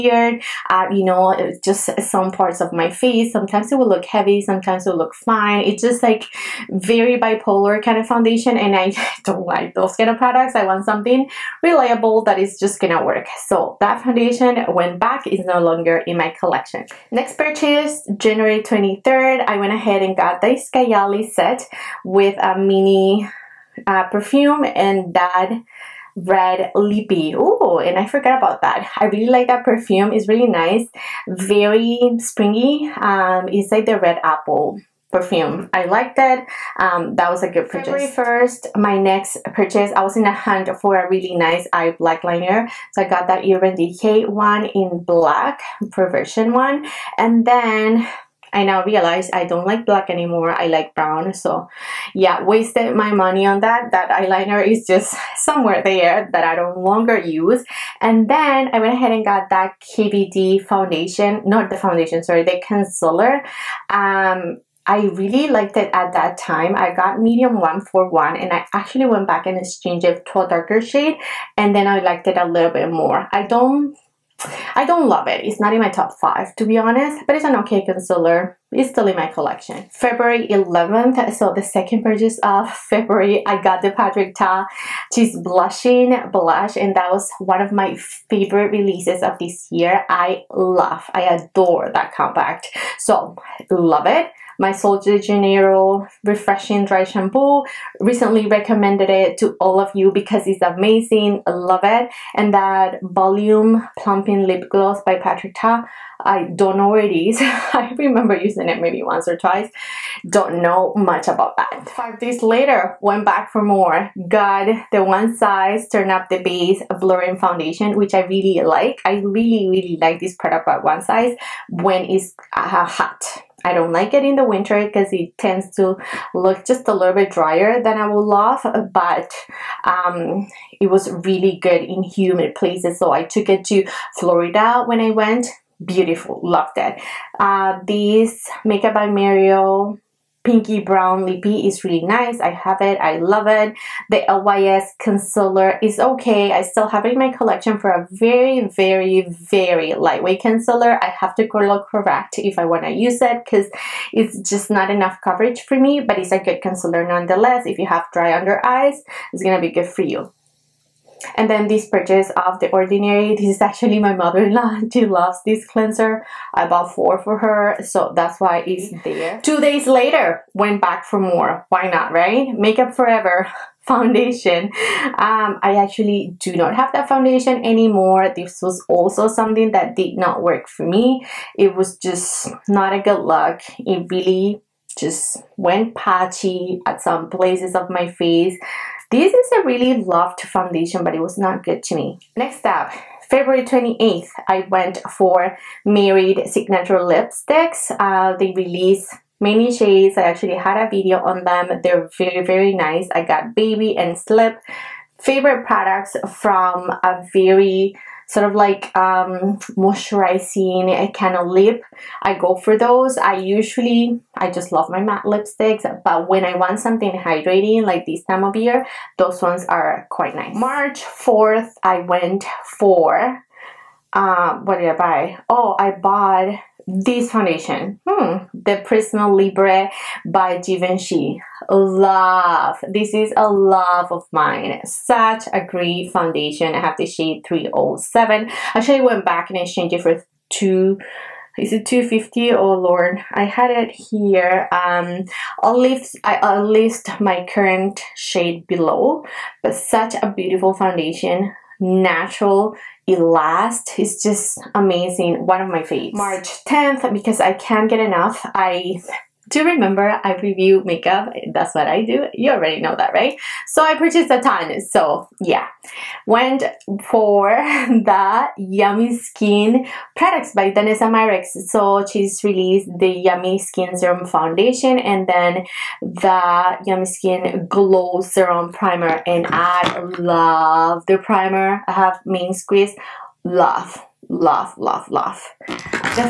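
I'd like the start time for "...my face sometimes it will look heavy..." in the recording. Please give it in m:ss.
0:02.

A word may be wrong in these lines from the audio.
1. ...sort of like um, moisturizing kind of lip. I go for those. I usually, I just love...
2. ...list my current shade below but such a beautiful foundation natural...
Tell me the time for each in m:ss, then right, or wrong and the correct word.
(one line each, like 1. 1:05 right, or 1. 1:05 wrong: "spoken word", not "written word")
1. 3:28 right
2. 4:06 right.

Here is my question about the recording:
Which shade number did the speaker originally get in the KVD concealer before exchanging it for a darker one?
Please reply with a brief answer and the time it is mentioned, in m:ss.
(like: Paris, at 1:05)
Medium 141, at 1:07.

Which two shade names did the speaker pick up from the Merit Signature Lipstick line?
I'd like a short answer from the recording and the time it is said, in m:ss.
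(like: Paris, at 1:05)
Baby and Slip, at 3:23.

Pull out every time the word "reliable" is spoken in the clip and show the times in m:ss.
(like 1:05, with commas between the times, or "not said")
0:11.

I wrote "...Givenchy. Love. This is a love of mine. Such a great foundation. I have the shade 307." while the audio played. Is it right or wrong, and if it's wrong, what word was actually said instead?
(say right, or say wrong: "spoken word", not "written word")
right.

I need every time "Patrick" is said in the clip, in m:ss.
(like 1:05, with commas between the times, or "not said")
1:23, 1:45.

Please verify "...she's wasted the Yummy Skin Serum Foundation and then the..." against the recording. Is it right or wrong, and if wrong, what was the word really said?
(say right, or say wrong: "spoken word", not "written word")
wrong: "released", not "wasted".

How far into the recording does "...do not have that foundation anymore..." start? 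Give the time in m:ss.
2:56.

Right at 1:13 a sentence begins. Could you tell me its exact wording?
I don't I don't love it.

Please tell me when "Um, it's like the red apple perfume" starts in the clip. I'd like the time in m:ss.
0:32.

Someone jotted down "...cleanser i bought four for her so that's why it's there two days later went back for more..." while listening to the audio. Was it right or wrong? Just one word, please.
right.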